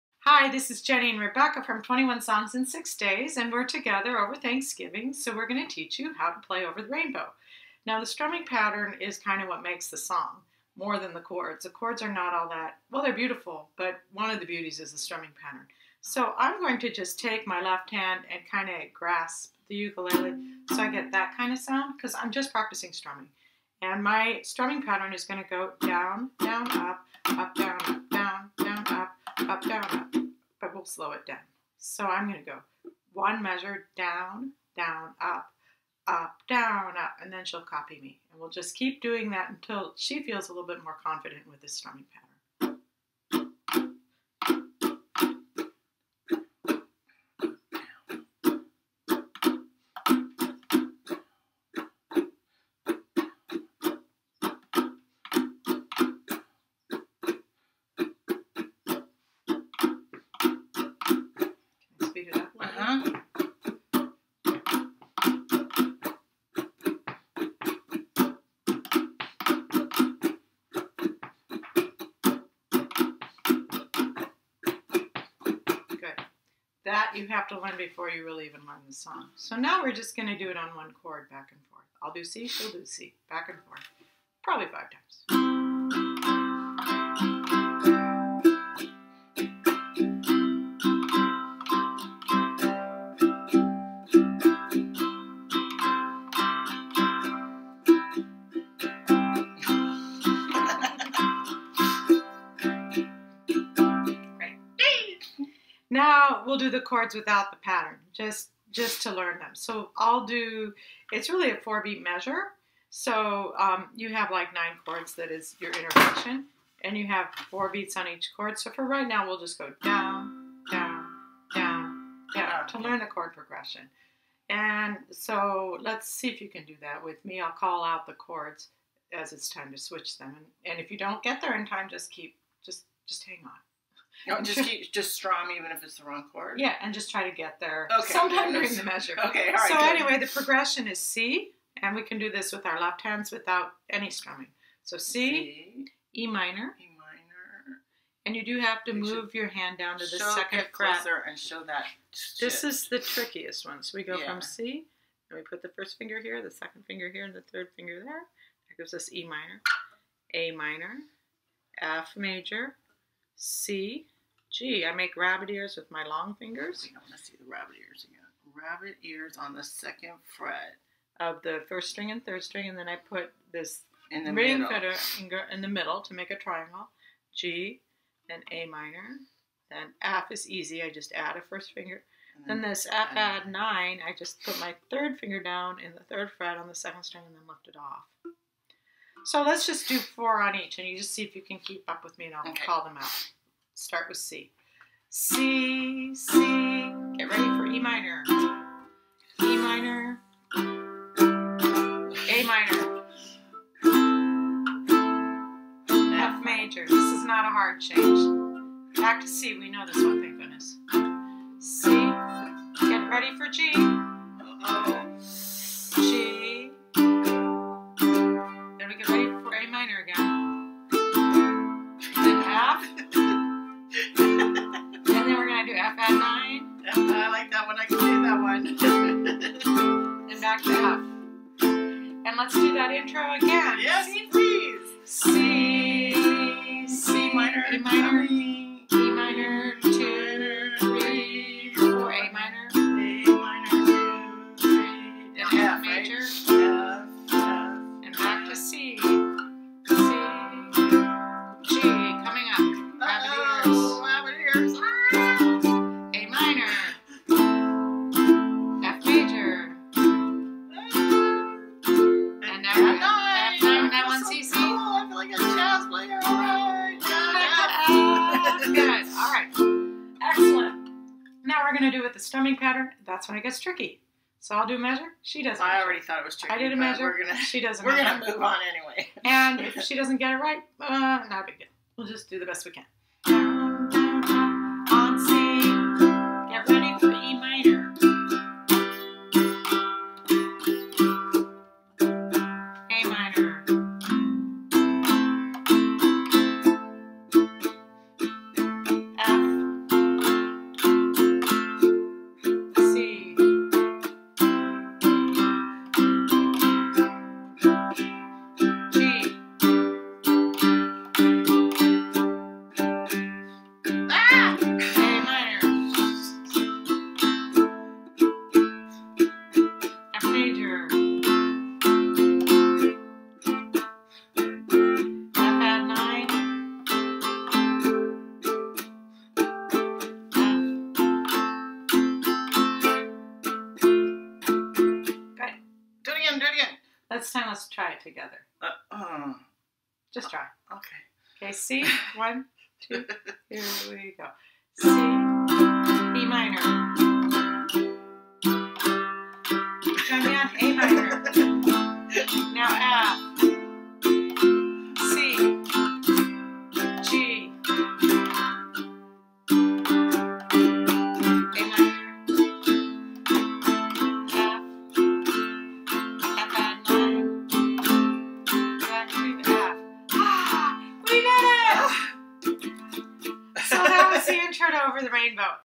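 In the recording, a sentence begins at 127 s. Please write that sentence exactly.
I'll call out the chords as it's time to switch them.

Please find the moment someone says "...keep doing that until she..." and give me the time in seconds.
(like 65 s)
38 s.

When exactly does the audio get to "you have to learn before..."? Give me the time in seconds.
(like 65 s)
77 s.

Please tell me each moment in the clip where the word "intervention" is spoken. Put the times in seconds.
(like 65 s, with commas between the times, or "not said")
115 s.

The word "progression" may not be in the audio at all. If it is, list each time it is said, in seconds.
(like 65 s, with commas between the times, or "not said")
123 s, 140 s.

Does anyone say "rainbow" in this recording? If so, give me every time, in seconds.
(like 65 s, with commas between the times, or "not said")
6 s, 375 s.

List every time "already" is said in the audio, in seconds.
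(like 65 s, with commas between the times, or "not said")
275 s.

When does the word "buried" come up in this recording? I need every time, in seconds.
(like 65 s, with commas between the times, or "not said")
not said.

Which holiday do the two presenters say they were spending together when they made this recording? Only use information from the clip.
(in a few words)
Thanksgiving.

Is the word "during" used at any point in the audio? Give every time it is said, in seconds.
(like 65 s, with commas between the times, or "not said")
138 s.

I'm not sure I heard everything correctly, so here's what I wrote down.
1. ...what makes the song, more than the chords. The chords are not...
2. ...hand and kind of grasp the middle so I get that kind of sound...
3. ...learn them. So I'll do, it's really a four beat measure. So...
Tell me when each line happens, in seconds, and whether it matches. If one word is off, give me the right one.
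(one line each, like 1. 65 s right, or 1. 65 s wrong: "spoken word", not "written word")
1. 9 s right
2. 17 s wrong: "ukulele", not "middle"
3. 109 s right.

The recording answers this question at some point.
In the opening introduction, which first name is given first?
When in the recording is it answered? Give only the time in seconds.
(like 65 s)
0 s.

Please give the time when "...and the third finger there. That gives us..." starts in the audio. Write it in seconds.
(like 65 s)
157 s.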